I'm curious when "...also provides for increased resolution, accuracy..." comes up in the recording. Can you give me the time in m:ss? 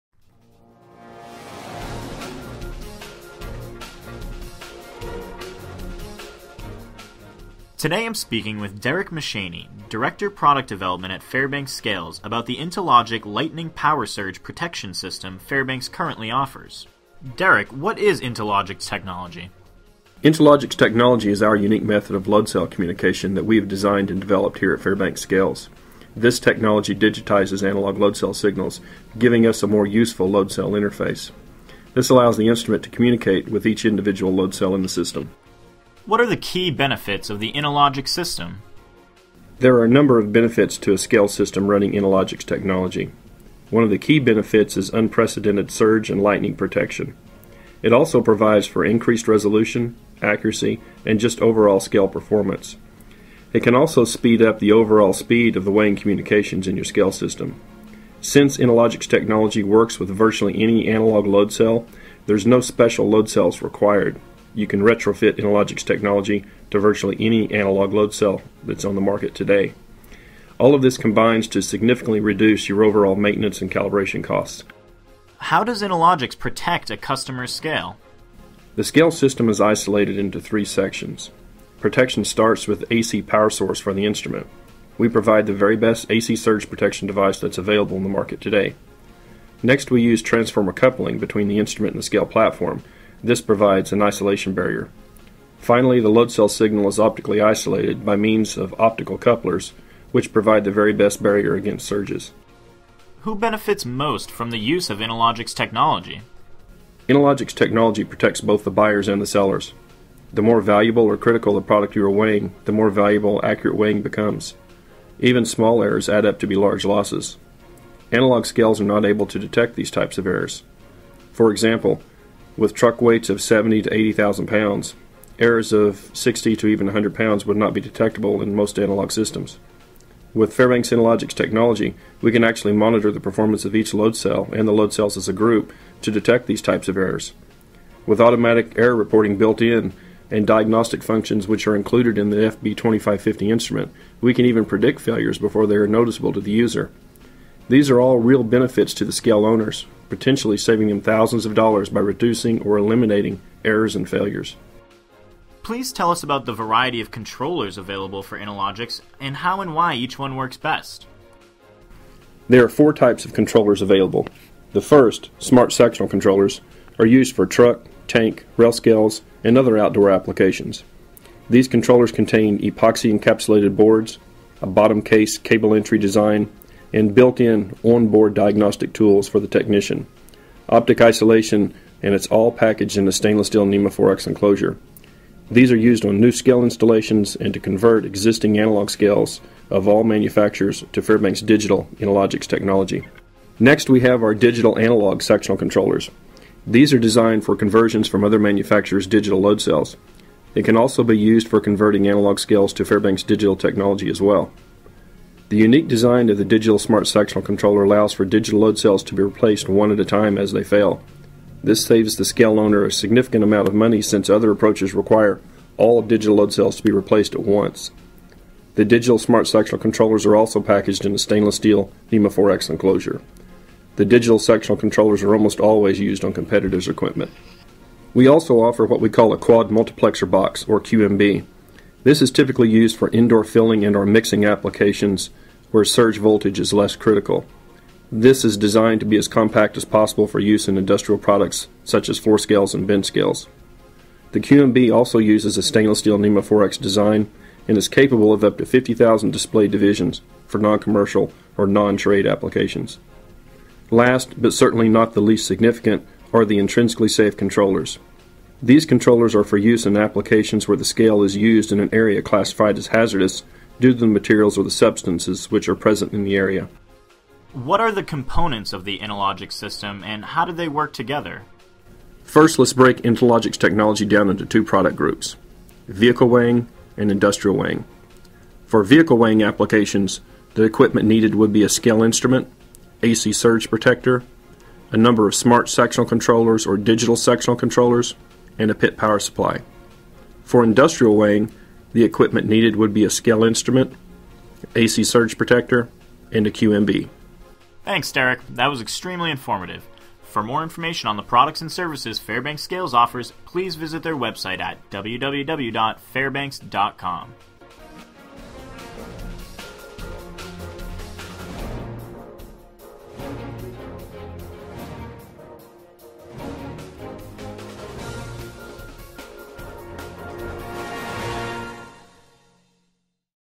0:47.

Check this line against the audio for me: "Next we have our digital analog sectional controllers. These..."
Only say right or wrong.
right.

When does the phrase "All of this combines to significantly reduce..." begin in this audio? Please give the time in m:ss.
1:10.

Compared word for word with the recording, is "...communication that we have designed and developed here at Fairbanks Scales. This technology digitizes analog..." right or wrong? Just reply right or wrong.
right.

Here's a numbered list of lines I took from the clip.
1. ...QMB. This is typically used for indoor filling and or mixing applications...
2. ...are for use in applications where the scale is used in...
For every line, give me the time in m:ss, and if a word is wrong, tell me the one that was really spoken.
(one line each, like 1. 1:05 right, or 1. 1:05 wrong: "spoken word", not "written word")
1. 3:50 right
2. 4:19 right.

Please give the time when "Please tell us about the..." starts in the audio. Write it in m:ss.
2:35.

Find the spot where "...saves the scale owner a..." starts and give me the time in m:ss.
3:31.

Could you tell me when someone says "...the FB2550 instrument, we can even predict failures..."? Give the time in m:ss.
2:22.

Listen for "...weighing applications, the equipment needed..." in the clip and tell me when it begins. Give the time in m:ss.
4:39.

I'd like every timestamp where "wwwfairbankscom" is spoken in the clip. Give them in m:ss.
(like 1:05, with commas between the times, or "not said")
5:04.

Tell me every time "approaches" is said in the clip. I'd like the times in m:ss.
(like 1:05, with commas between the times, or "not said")
3:34.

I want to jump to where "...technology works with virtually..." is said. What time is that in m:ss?
0:59.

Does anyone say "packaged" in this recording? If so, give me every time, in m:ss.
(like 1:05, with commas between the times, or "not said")
3:02, 3:40.